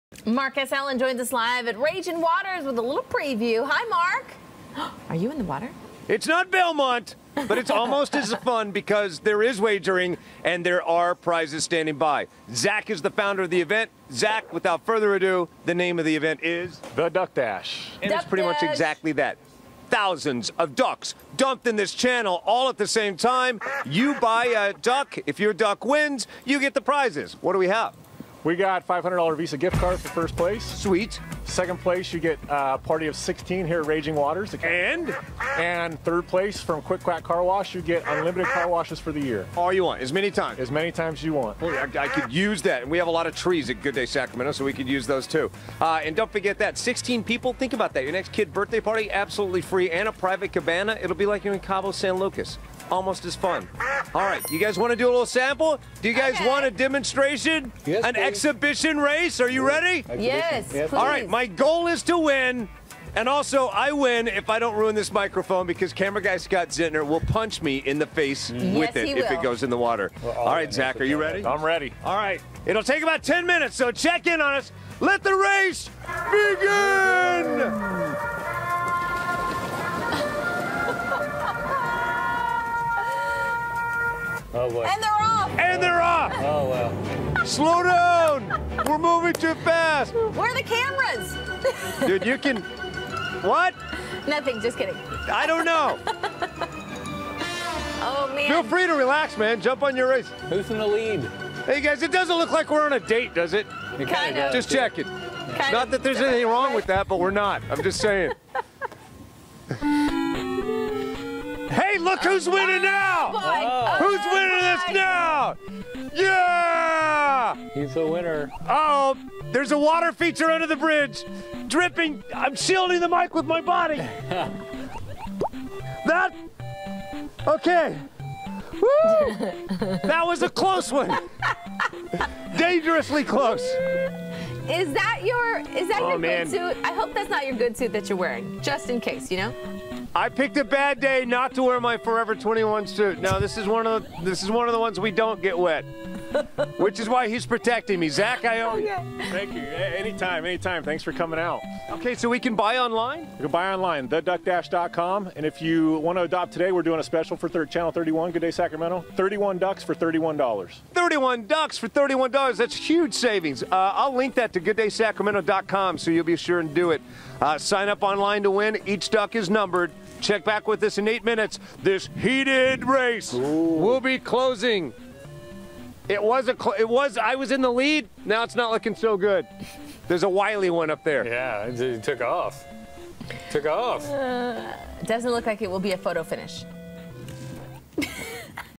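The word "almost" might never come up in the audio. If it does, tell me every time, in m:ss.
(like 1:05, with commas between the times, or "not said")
0:07, 0:52.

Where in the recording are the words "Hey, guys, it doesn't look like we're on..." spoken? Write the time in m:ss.
1:41.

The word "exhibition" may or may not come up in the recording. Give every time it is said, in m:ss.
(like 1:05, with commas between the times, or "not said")
0:58.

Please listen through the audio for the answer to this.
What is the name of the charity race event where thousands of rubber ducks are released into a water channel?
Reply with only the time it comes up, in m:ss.
0:16.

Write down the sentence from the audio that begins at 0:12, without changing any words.
Zach is the founder of the event.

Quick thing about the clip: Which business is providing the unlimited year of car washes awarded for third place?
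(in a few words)
Quick Quack Car Wash.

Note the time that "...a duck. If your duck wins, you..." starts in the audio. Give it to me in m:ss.
0:24.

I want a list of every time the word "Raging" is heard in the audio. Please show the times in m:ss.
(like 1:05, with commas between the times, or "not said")
0:01, 0:33.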